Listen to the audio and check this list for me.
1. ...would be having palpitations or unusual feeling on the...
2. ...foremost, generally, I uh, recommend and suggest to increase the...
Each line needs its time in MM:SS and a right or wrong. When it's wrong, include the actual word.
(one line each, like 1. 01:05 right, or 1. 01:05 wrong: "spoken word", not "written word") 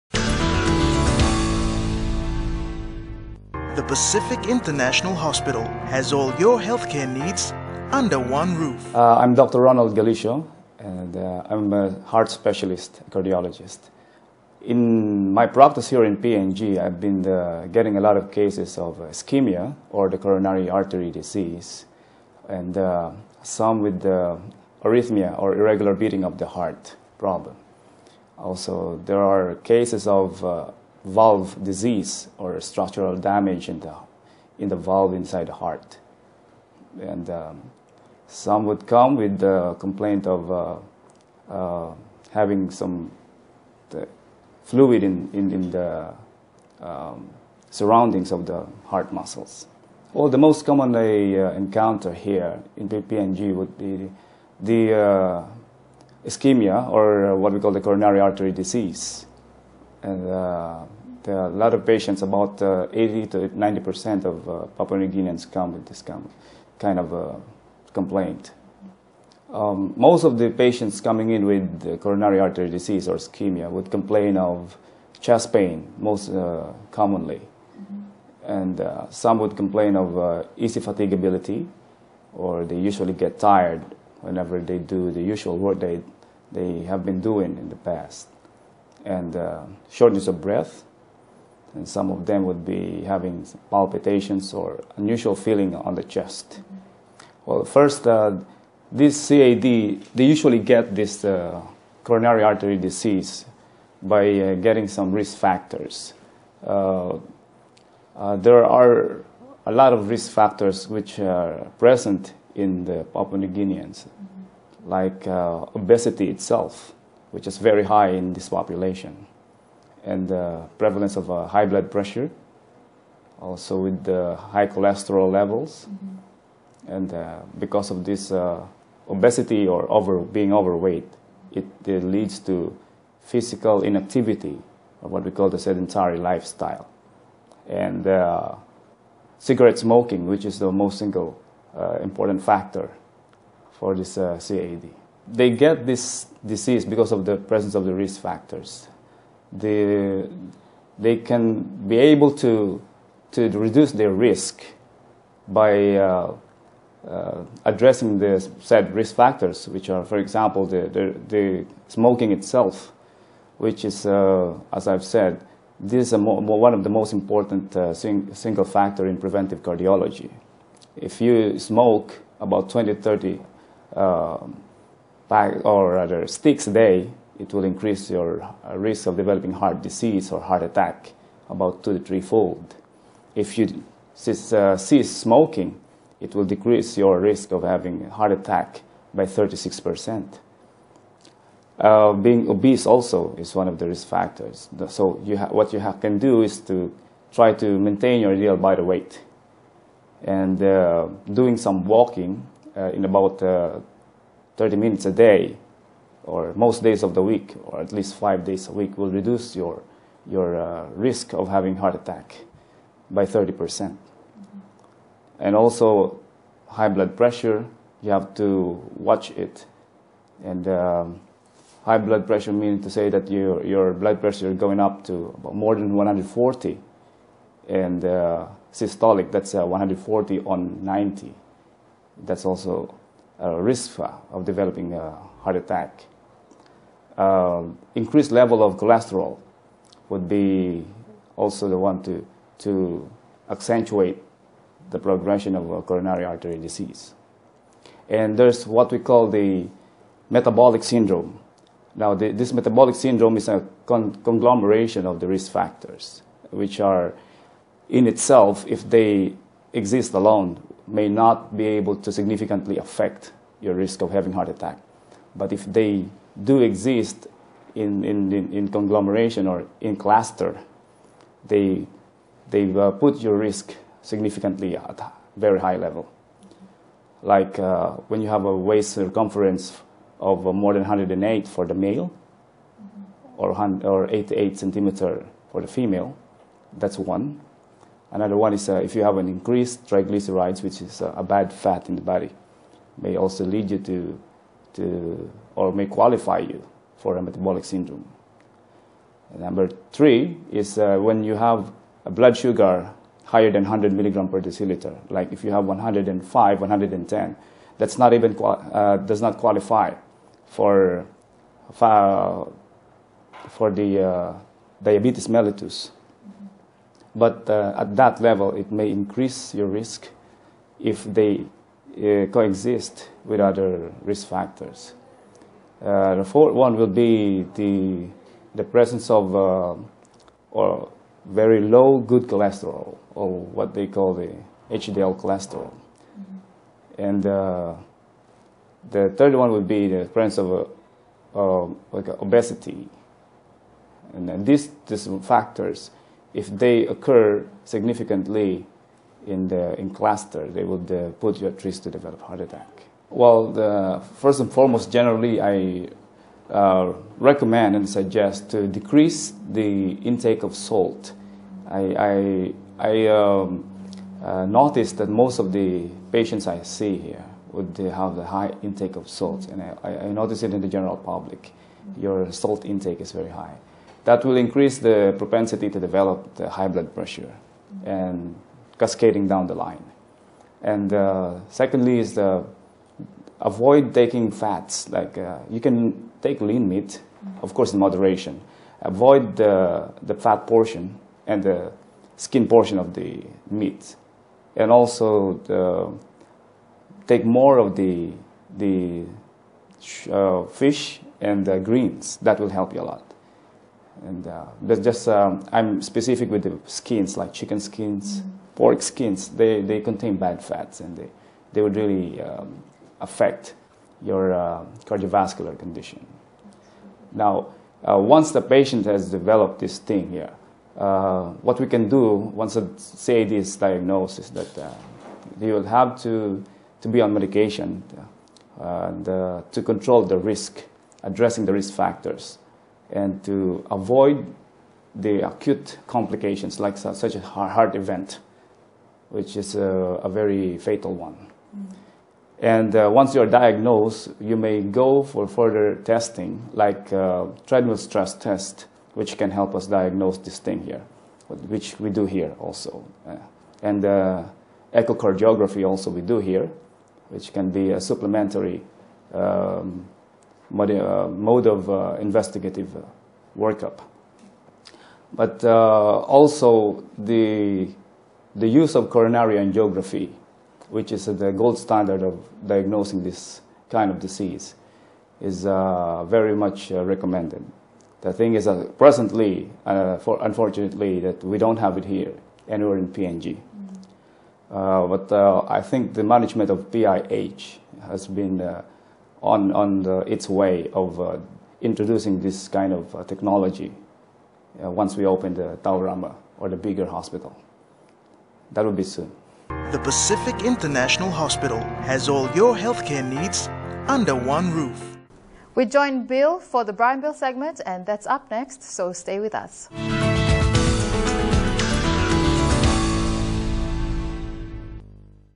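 1. 01:32 right
2. 05:54 wrong: "decrease", not "increase".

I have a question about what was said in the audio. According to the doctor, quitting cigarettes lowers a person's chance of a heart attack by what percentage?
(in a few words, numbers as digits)
36%.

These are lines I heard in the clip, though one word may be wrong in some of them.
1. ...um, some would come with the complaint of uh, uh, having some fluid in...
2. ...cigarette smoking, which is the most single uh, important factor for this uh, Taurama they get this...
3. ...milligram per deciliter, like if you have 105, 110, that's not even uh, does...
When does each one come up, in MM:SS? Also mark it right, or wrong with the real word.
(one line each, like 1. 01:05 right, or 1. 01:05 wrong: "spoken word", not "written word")
1. 00:37 right
2. 02:19 wrong: "CAD", not "Taurama"
3. 05:03 right.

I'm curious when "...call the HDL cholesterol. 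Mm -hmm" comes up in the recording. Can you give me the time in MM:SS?
05:33.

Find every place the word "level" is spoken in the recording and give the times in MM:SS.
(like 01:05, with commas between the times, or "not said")
02:05, 03:58, 04:35, 05:18.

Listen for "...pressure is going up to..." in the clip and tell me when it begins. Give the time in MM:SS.
03:44.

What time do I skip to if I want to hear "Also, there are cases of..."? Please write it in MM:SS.
00:28.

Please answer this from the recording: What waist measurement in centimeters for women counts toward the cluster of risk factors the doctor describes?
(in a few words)
88.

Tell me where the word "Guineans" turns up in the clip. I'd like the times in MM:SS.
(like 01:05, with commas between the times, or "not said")
01:05, 01:53.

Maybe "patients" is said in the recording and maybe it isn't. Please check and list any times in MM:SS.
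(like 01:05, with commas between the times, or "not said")
01:01, 01:10, 06:06, 06:58.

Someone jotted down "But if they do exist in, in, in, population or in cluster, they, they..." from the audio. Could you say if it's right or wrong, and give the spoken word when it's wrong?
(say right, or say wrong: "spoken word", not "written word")
wrong: "conglomeration", not "population".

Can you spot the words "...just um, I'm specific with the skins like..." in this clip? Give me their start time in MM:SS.
06:44.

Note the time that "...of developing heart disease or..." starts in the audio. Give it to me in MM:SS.
02:59.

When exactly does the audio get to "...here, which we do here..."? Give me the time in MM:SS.
07:30.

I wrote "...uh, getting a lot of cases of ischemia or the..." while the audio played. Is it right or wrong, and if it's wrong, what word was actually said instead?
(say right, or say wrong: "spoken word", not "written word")
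right.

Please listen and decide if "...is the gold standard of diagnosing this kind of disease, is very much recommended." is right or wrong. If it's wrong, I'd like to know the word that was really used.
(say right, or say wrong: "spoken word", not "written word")
right.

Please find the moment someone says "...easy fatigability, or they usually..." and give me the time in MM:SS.
01:20.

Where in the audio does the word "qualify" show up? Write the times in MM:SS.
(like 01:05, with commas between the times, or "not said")
04:55, 05:09.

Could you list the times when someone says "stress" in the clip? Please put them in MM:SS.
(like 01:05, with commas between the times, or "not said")
07:27.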